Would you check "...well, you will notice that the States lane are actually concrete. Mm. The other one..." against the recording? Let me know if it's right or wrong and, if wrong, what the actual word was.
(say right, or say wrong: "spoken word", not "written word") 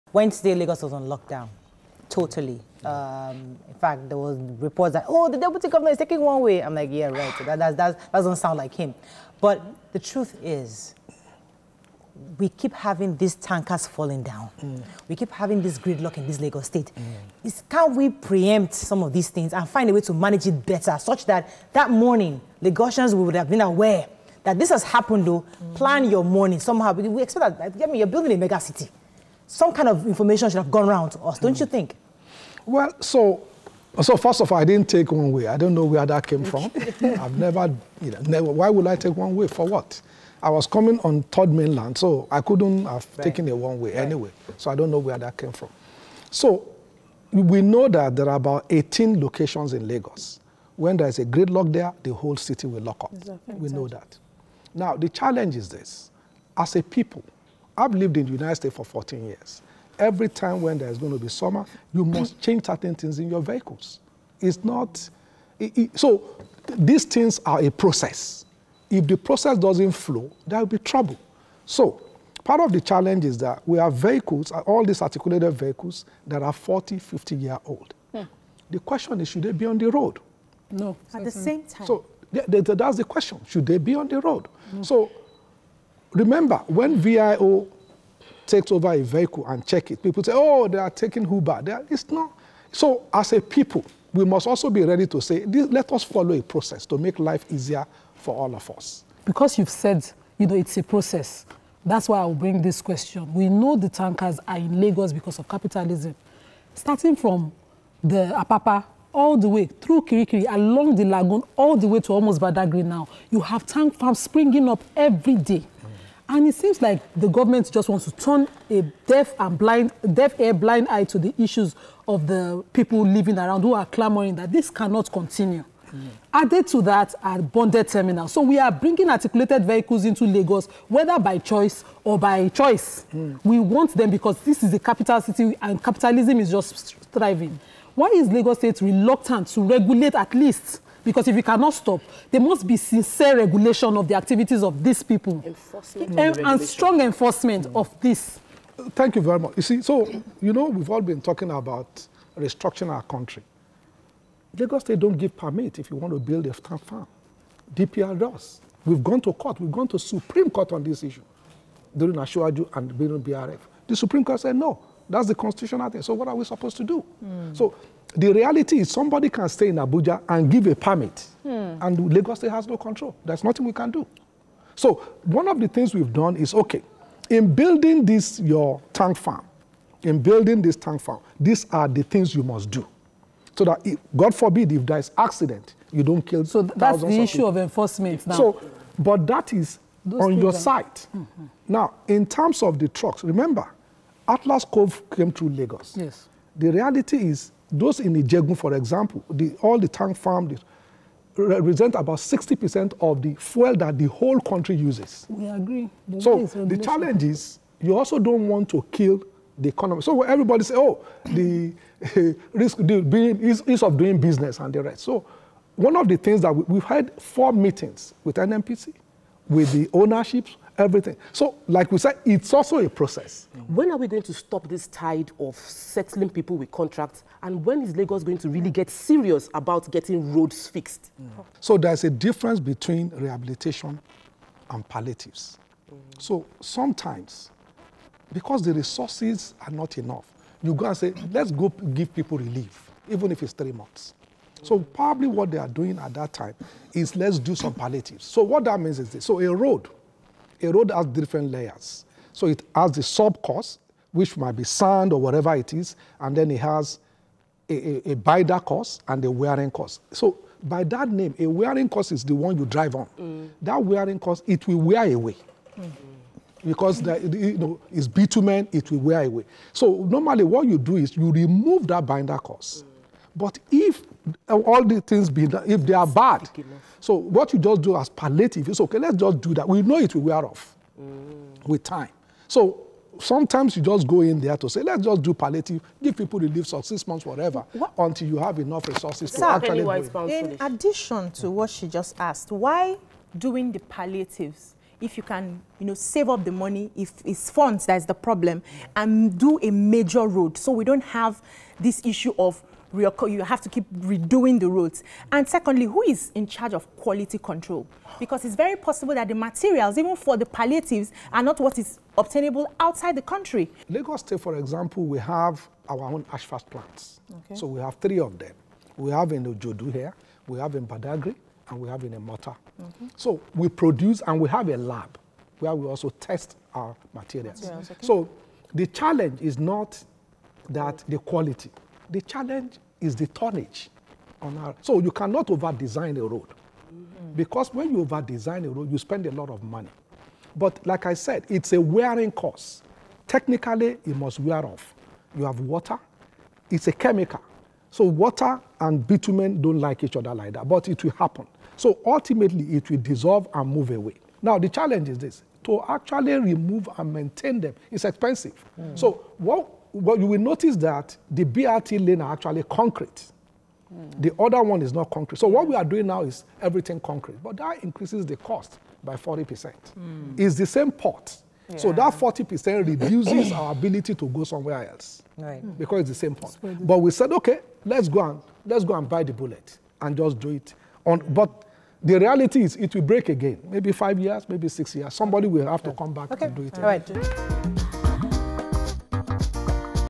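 wrong: "BRT", not "States".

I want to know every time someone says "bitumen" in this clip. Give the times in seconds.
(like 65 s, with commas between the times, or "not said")
268 s, 349 s.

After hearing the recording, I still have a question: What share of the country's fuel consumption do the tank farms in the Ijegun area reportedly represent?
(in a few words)
60%.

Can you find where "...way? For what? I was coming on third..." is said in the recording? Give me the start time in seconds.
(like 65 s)
39 s.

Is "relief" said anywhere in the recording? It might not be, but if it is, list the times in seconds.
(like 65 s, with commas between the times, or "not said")
242 s, 286 s.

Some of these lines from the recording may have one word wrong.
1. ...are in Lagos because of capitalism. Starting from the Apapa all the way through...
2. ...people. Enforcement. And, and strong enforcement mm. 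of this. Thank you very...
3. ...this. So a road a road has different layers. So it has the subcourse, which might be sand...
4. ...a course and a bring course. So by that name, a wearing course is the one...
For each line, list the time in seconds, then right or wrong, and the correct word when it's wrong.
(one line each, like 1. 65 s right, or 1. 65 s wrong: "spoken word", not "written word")
1. 104 s right
2. 145 s right
3. 249 s right
4. 258 s wrong: "wearing", not "bring".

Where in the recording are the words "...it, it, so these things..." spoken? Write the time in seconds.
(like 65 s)
65 s.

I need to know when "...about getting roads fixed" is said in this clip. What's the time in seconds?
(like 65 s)
229 s.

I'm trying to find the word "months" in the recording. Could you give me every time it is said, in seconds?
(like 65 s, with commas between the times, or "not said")
243 s, 287 s.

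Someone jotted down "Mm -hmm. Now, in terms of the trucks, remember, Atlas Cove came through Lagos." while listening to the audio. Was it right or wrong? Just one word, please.
right.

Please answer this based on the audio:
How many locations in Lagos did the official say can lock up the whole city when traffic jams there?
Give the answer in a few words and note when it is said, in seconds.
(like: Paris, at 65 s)
18, at 48 s.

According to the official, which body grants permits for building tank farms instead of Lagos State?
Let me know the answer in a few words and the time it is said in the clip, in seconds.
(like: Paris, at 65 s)
DPR, at 157 s.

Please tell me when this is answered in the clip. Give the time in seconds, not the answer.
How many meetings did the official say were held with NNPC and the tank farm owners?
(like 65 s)
217 s.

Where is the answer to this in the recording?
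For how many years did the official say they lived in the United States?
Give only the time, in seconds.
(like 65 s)
58 s.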